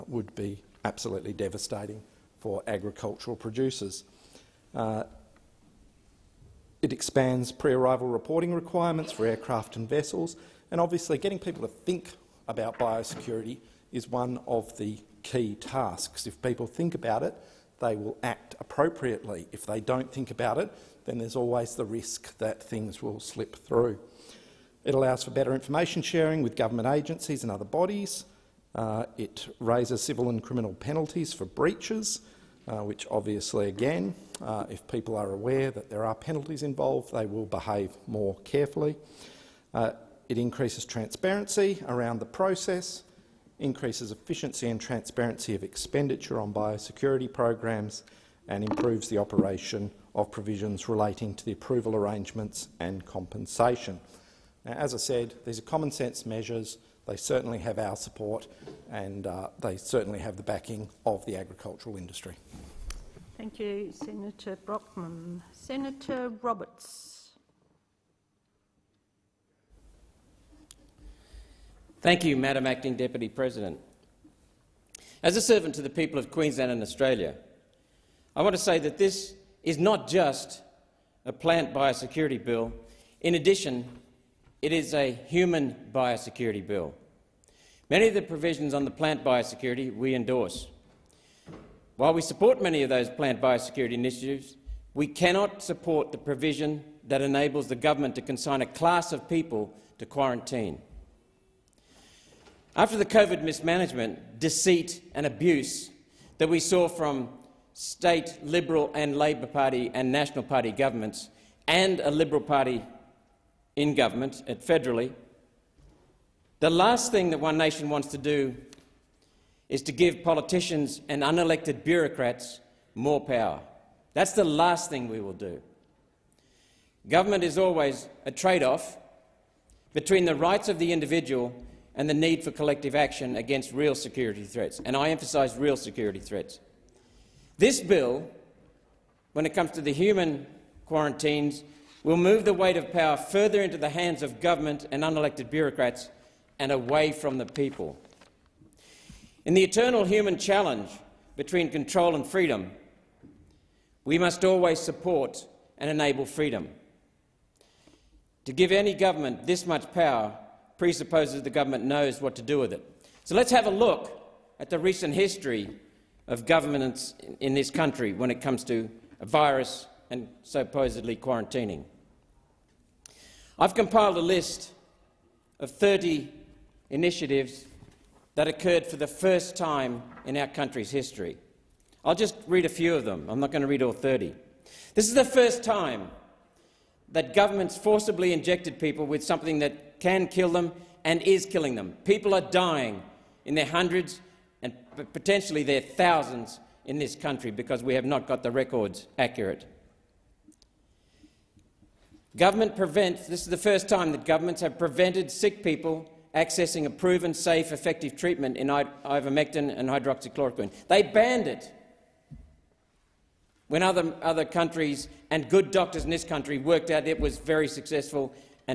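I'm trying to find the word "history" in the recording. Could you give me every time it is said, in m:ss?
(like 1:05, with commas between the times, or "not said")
2:45, 3:00.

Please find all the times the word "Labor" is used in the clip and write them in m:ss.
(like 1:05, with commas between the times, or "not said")
1:49.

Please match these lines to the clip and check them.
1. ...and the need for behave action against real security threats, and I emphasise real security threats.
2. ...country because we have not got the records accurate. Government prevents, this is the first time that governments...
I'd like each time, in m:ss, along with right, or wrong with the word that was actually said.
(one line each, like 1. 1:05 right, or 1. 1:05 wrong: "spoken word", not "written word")
1. 2:11 wrong: "collective", not "behave"
2. 3:17 right.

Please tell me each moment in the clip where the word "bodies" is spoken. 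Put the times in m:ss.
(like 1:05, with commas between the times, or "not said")
0:27.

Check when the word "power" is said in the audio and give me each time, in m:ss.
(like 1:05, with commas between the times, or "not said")
2:03, 2:22, 2:39.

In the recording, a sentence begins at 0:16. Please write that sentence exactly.
If people think about it, they will act appropriately.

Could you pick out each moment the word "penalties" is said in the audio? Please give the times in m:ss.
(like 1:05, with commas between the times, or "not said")
0:30, 0:36.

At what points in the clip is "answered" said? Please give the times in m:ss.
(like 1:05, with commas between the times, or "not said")
not said.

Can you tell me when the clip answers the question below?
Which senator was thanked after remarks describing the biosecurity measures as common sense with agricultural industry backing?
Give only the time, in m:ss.
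1:03.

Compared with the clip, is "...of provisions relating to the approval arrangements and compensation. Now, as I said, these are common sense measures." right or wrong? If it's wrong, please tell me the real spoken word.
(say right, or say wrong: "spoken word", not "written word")
right.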